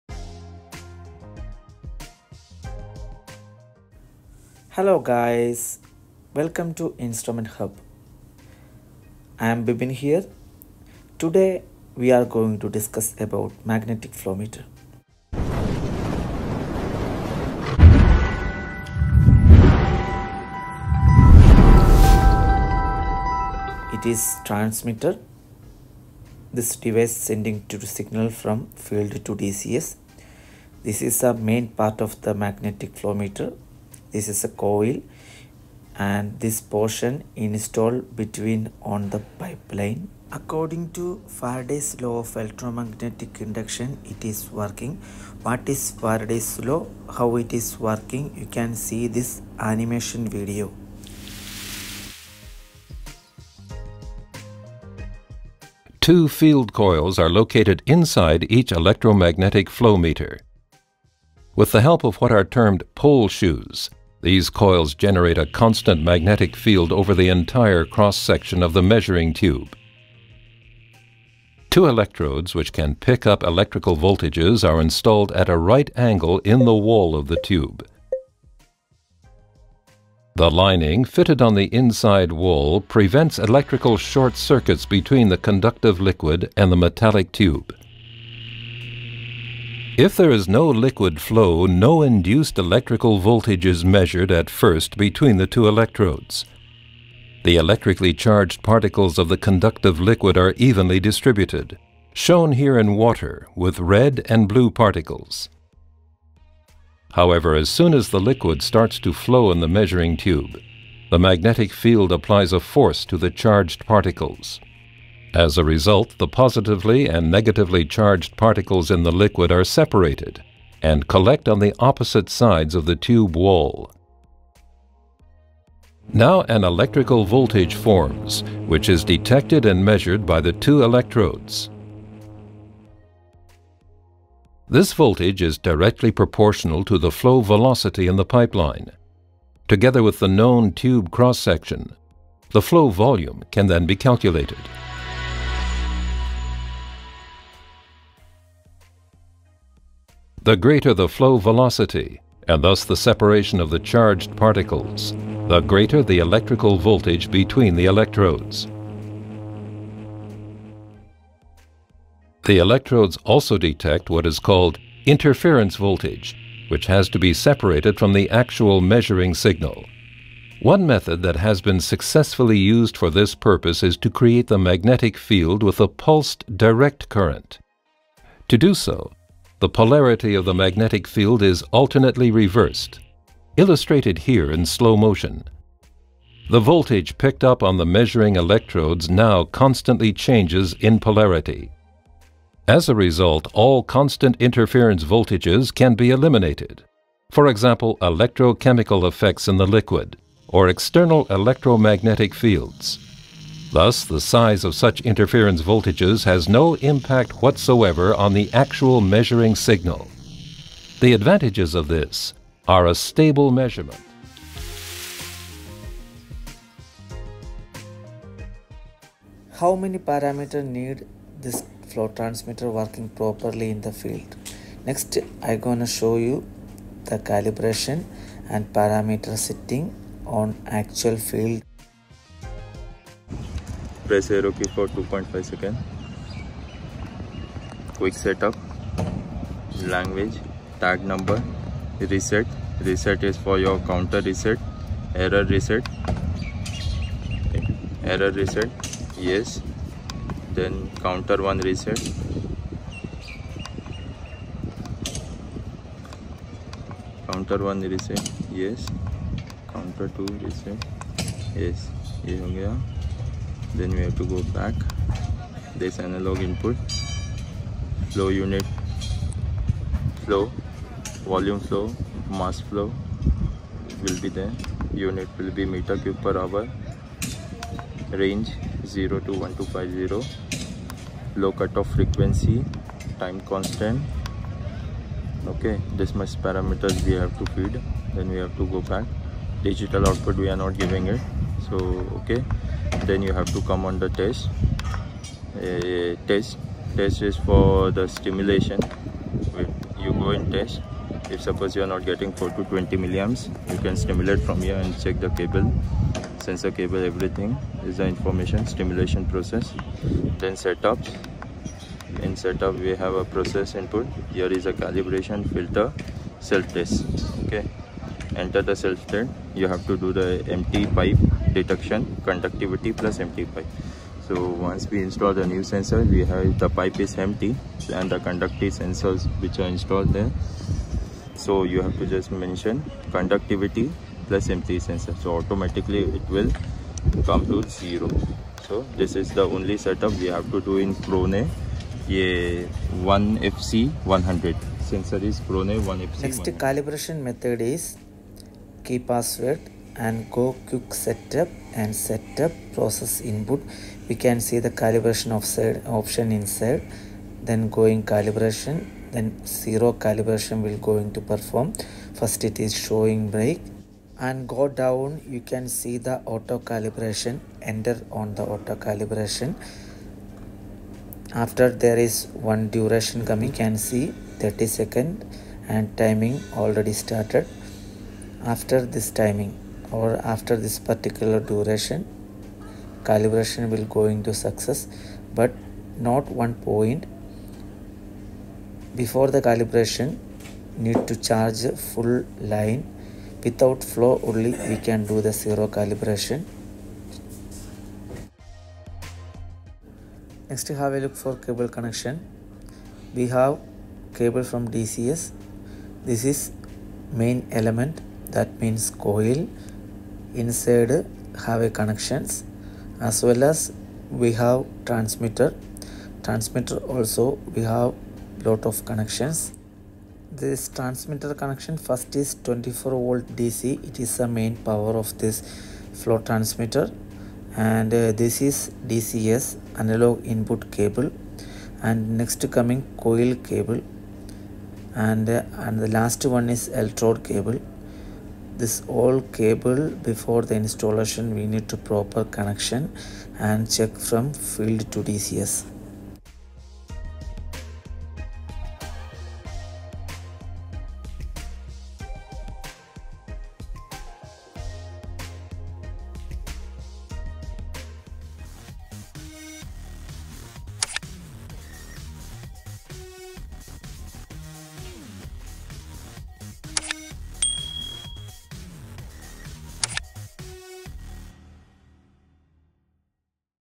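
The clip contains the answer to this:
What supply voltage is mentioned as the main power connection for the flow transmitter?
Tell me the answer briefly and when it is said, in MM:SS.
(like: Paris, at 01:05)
24 volt DC, at 07:02.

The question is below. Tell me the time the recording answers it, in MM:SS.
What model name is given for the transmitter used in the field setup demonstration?
05:43.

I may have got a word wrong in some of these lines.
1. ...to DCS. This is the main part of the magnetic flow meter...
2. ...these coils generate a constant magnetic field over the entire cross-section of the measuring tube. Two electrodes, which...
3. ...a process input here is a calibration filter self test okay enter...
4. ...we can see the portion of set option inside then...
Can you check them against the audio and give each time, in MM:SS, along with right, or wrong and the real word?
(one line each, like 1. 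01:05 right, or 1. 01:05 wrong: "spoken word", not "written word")
1. 00:29 right
2. 01:04 right
3. 05:13 right
4. 05:54 wrong: "calibration", not "portion".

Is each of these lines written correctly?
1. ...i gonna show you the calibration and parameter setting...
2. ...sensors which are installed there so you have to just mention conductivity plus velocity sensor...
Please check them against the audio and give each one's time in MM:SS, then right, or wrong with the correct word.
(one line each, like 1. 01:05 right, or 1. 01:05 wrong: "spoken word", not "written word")
1. 03:45 right
2. 05:28 wrong: "empty", not "velocity".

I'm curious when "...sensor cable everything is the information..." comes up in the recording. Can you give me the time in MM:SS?
05:06.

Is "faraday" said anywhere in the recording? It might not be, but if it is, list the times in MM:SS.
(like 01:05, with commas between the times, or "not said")
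00:41, 00:46.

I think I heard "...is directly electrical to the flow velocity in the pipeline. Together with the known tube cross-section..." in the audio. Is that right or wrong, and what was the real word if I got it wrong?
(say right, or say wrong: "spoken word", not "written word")
wrong: "proportional", not "electrical".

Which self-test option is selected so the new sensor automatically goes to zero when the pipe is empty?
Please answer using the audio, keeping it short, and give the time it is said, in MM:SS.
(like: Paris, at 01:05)
conductivity plus empty pipe, at 05:22.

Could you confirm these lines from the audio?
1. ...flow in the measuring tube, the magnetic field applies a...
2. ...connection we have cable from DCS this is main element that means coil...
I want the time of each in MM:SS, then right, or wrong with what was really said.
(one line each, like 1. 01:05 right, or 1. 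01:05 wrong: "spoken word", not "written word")
1. 01:49 right
2. 06:41 right.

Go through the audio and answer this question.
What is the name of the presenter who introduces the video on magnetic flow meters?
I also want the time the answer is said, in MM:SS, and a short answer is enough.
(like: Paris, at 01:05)
Bibin, at 00:09.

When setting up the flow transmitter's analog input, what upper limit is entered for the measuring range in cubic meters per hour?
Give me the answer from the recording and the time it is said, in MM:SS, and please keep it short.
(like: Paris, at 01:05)
1250, at 04:38.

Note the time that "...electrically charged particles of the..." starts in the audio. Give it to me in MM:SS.
01:37.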